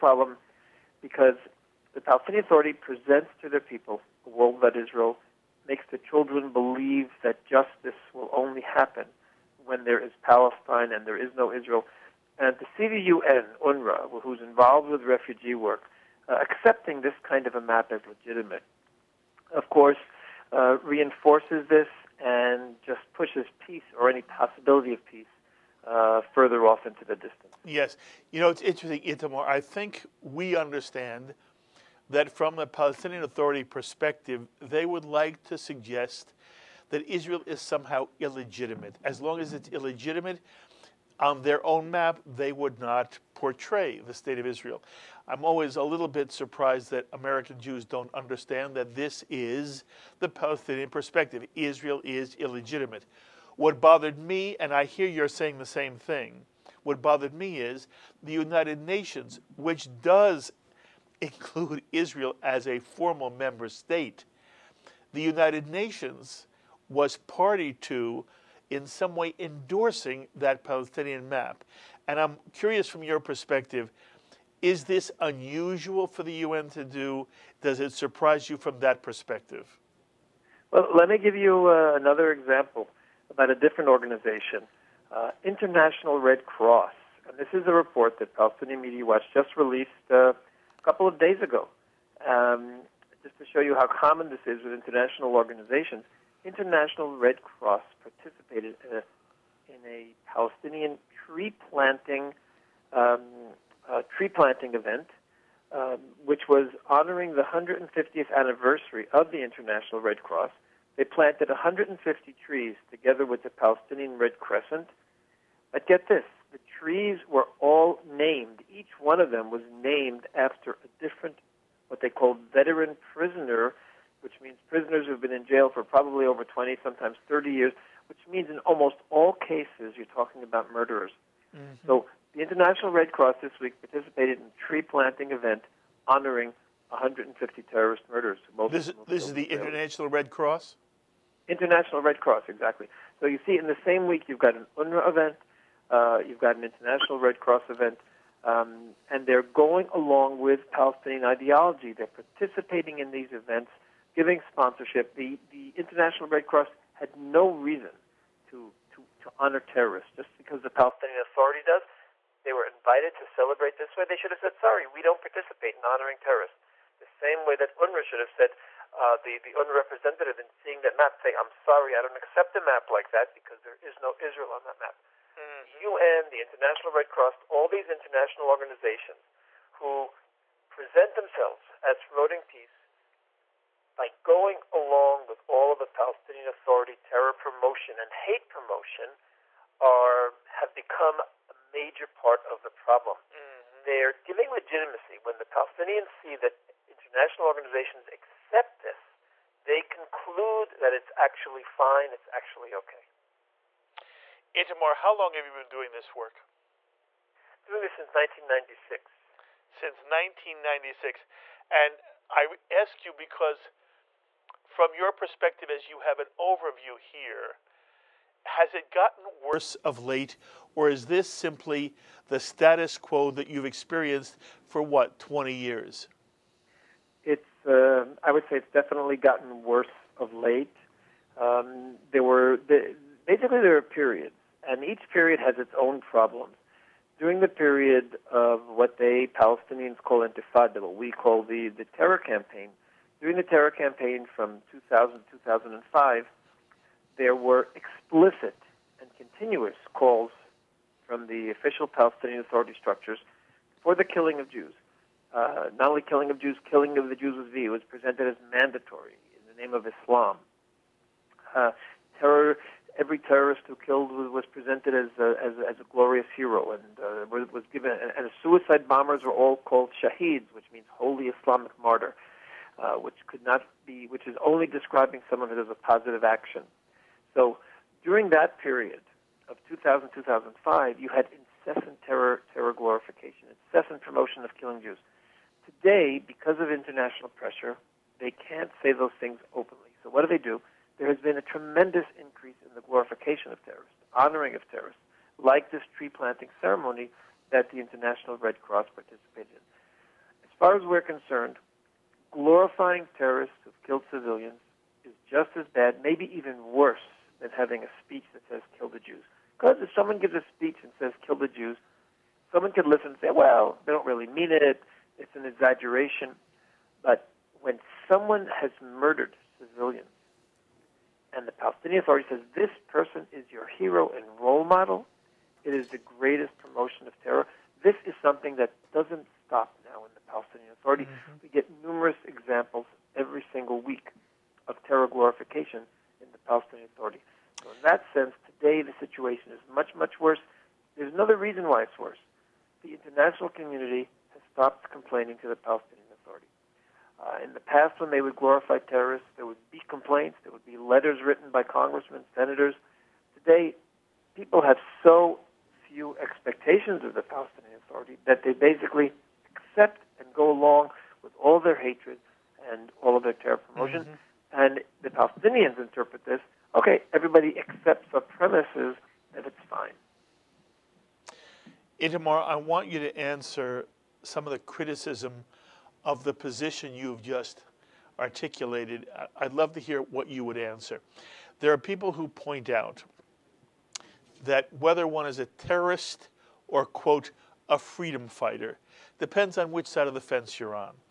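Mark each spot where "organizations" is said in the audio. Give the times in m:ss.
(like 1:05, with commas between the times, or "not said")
1:23, 1:35, 2:58, 3:17.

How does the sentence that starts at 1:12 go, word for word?
And I'm curious from your perspective is this unusual for the UN to do?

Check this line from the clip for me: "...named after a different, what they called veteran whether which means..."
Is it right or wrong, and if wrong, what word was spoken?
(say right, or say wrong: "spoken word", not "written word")
wrong: "prisoner", not "whether".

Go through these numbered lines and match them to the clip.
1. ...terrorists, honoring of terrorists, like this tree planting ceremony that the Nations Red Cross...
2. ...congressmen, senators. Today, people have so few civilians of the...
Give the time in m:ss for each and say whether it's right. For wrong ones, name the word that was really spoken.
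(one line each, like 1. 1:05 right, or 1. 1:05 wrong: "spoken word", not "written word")
1. 4:53 wrong: "International", not "Nations"
2. 5:51 wrong: "expectations", not "civilians".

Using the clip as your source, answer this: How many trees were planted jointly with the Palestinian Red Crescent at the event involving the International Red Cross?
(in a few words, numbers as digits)
150.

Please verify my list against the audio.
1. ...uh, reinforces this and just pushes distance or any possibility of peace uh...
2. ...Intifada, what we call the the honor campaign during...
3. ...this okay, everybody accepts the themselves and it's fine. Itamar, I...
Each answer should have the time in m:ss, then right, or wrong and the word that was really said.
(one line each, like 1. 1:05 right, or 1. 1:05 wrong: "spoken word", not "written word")
1. 0:20 wrong: "peace", not "distance"
2. 4:00 wrong: "terror", not "honor"
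3. 6:06 wrong: "premises", not "themselves".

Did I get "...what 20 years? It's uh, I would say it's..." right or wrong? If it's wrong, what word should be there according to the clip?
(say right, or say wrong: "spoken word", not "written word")
right.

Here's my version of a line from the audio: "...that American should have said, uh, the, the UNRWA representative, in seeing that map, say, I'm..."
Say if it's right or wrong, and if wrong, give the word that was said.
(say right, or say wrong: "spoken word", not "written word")
wrong: "UNRWA", not "American".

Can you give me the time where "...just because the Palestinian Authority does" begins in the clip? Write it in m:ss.
2:40.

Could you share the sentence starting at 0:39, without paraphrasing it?
As long as it's illegitimate, on their own map, they would not portray the state of Israel.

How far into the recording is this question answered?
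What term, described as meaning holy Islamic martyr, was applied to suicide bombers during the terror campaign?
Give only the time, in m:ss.
4:29.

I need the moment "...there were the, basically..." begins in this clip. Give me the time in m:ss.
3:52.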